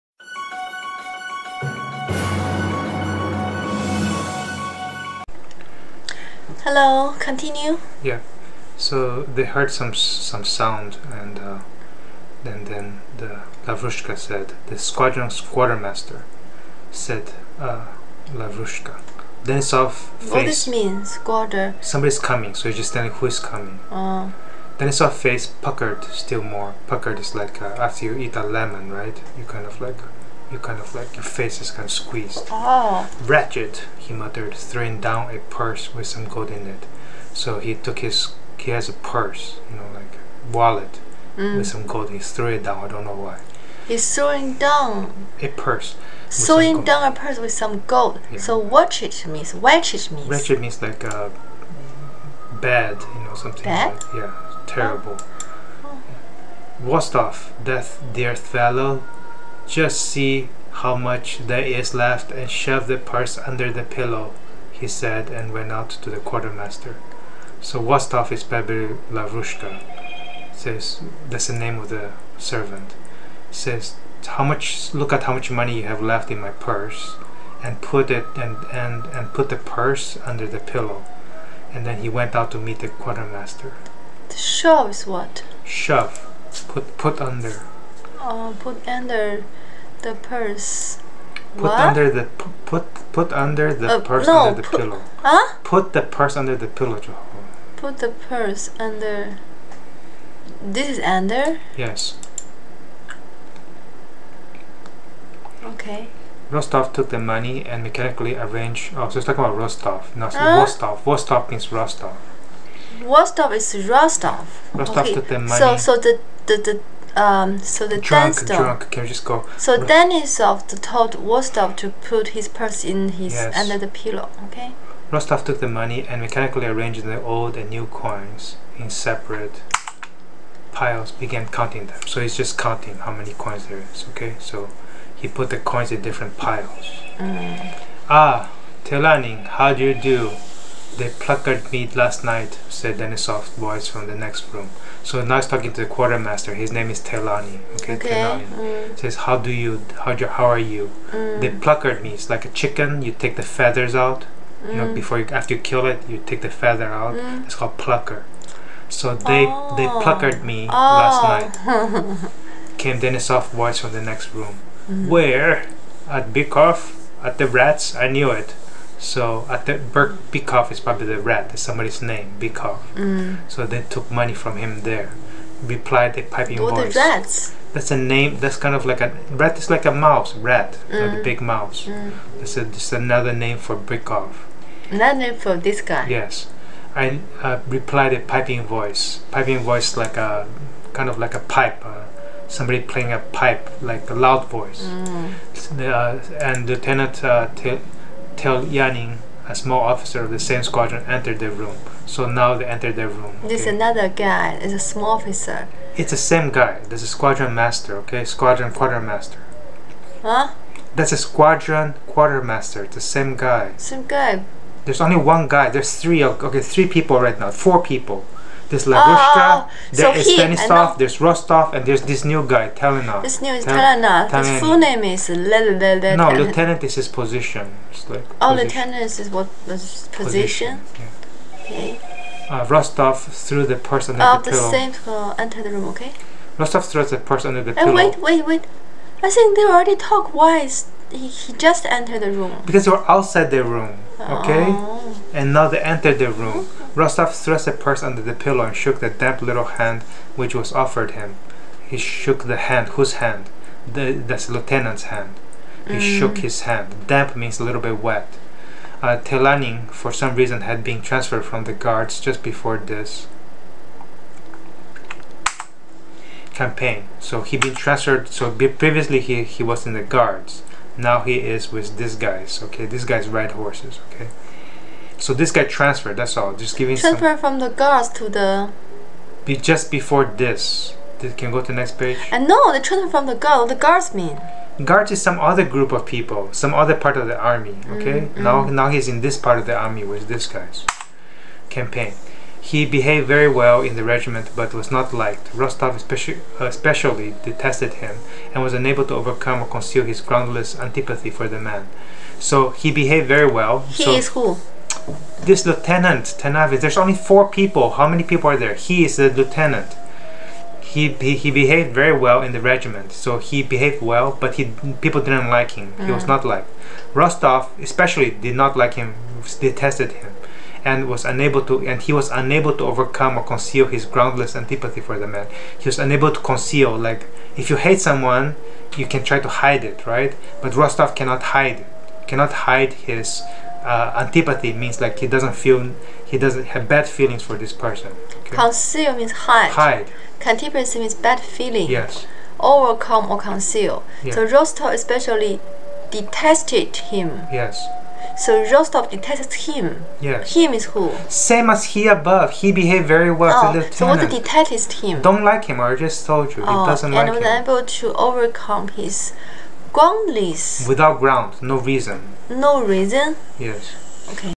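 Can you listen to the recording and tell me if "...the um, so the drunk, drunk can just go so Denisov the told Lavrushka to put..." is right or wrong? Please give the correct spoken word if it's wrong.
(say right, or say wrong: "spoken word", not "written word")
wrong: "Rostov", not "Lavrushka".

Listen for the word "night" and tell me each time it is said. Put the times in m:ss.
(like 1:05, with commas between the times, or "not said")
2:22, 2:41.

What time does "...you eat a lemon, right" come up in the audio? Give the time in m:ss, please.
0:28.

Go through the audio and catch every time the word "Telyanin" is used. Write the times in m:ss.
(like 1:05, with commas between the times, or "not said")
2:18, 3:18, 4:19.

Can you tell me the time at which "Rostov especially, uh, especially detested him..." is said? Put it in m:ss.
4:55.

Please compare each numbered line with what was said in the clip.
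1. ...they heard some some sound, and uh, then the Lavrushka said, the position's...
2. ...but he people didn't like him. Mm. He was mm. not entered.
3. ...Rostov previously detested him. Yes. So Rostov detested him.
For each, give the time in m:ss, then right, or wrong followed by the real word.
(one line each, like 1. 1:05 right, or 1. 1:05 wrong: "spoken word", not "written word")
1. 0:09 wrong: "squadron", not "position"
2. 5:14 wrong: "liked", not "entered"
3. 5:44 wrong: "especially", not "previously".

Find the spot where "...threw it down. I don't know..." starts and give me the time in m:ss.
0:42.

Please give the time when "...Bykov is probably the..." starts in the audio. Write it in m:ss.
2:50.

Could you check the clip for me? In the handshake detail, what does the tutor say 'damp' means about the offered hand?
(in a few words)
A little bit wet.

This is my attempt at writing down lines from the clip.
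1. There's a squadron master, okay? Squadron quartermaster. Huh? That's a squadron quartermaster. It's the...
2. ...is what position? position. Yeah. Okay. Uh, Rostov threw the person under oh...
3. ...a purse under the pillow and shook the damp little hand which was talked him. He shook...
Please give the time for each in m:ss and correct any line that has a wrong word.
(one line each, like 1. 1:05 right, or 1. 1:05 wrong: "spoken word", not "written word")
1. 3:26 right
2. 3:49 right
3. 4:07 wrong: "offered", not "talked".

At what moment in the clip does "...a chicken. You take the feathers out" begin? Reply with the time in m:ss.
2:32.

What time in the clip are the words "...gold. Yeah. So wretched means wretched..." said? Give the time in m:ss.
0:47.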